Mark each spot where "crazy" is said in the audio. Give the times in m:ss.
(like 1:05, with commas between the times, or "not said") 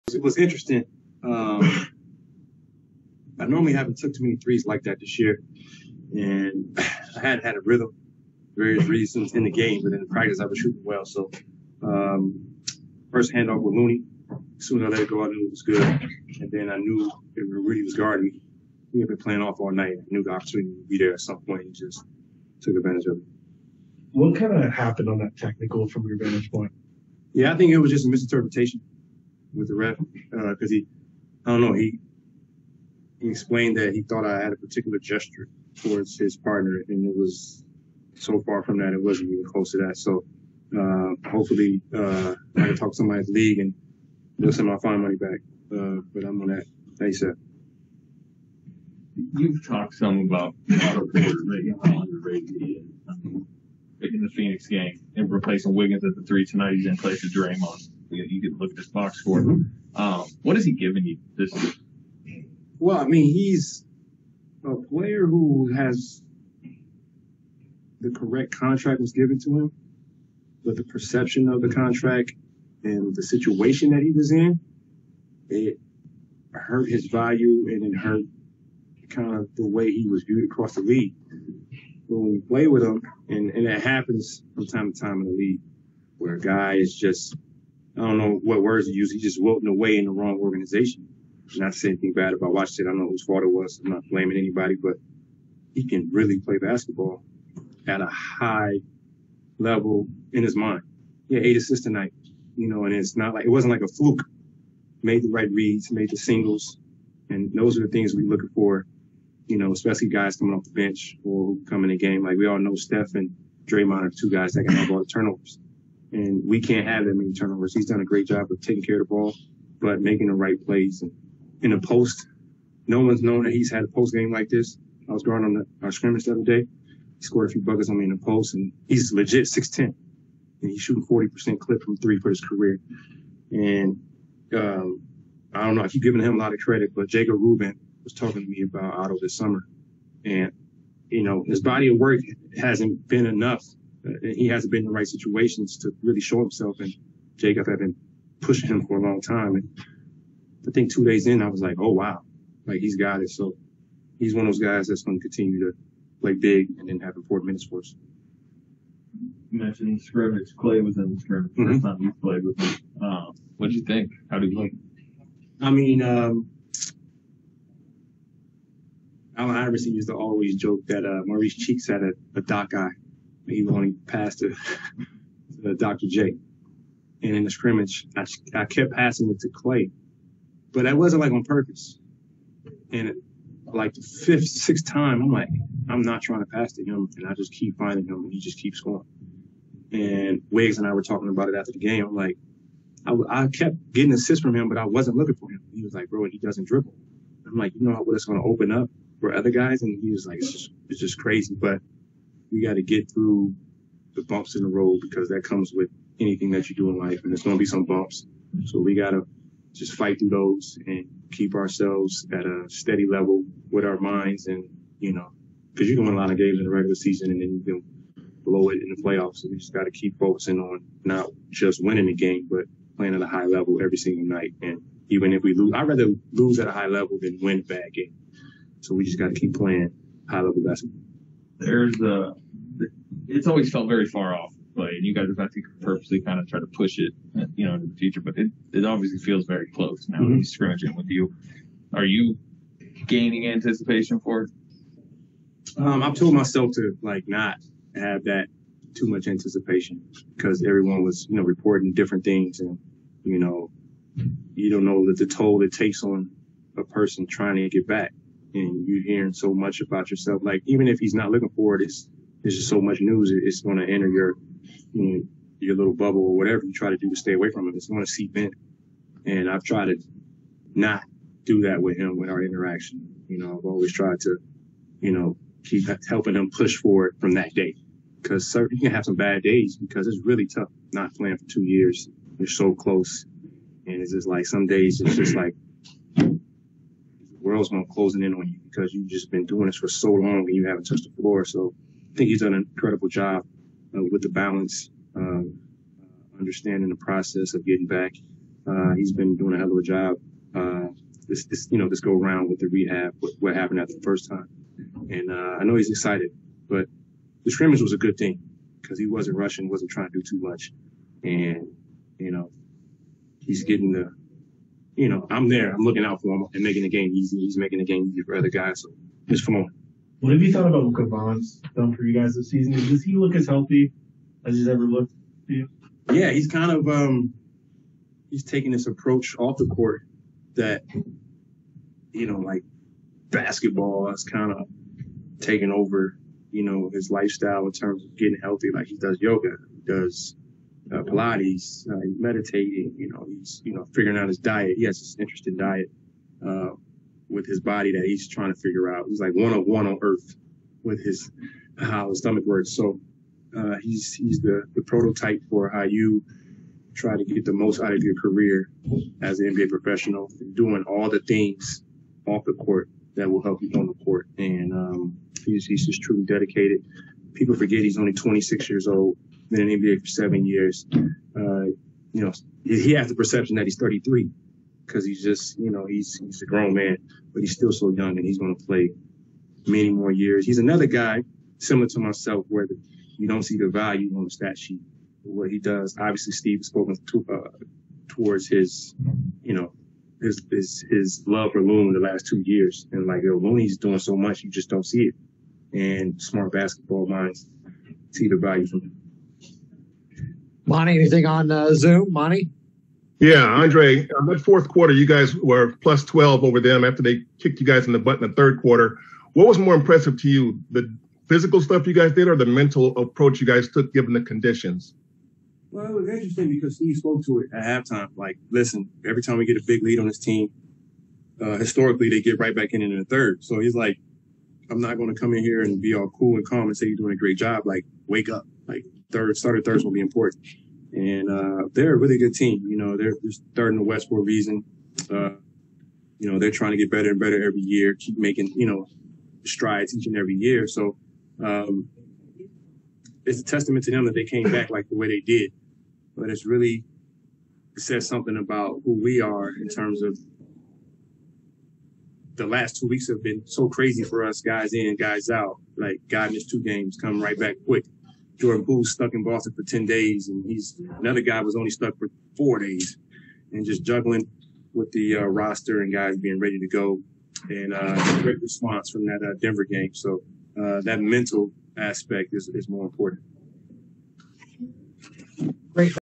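3:21, 7:33.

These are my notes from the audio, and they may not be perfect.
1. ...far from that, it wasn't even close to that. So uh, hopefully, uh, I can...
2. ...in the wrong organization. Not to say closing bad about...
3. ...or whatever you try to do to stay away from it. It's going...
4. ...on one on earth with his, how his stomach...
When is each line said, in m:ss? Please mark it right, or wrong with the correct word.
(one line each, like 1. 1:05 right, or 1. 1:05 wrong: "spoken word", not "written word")
1. 0:38 right
2. 1:29 wrong: "anything", not "closing"
3. 4:26 right
4. 5:49 right.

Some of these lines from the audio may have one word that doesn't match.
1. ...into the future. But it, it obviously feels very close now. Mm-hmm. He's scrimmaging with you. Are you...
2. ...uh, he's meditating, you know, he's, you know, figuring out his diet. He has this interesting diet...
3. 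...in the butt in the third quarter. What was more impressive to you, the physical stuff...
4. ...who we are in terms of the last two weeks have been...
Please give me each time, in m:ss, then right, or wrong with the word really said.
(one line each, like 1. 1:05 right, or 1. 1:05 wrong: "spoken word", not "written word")
1. 3:57 right
2. 5:41 right
3. 6:47 right
4. 7:28 right.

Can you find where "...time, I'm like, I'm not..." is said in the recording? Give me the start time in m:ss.
3:04.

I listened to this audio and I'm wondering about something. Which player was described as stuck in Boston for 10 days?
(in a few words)
Jordan Poole.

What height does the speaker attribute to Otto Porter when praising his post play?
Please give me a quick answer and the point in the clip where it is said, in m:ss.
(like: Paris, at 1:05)
6'10", at 2:09.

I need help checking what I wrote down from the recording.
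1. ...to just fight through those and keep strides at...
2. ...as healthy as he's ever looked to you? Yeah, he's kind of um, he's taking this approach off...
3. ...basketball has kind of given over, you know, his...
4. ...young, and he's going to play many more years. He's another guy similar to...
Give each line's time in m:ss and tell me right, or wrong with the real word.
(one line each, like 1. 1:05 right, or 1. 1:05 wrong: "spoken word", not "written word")
1. 3:29 wrong: "ourselves", not "strides"
2. 5:23 right
3. 5:33 wrong: "taken", not "given"
4. 6:17 right.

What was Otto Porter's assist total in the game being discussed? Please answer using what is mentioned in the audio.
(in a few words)
8.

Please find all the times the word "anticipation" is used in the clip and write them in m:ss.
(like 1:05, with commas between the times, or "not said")
4:03, 4:09.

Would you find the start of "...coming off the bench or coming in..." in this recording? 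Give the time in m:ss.
1:50.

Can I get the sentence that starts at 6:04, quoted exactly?
And um, he's, he's just truly dedicated.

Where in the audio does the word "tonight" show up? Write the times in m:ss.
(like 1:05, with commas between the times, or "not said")
0:56, 1:41.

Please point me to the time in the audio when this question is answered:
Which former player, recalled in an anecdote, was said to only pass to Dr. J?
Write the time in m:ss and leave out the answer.
2:51.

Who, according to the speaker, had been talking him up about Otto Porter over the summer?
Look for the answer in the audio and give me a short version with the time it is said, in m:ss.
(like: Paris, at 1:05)
Jacob Rubin, at 2:17.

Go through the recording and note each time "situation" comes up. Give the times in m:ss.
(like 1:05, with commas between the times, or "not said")
1:13, 2:25.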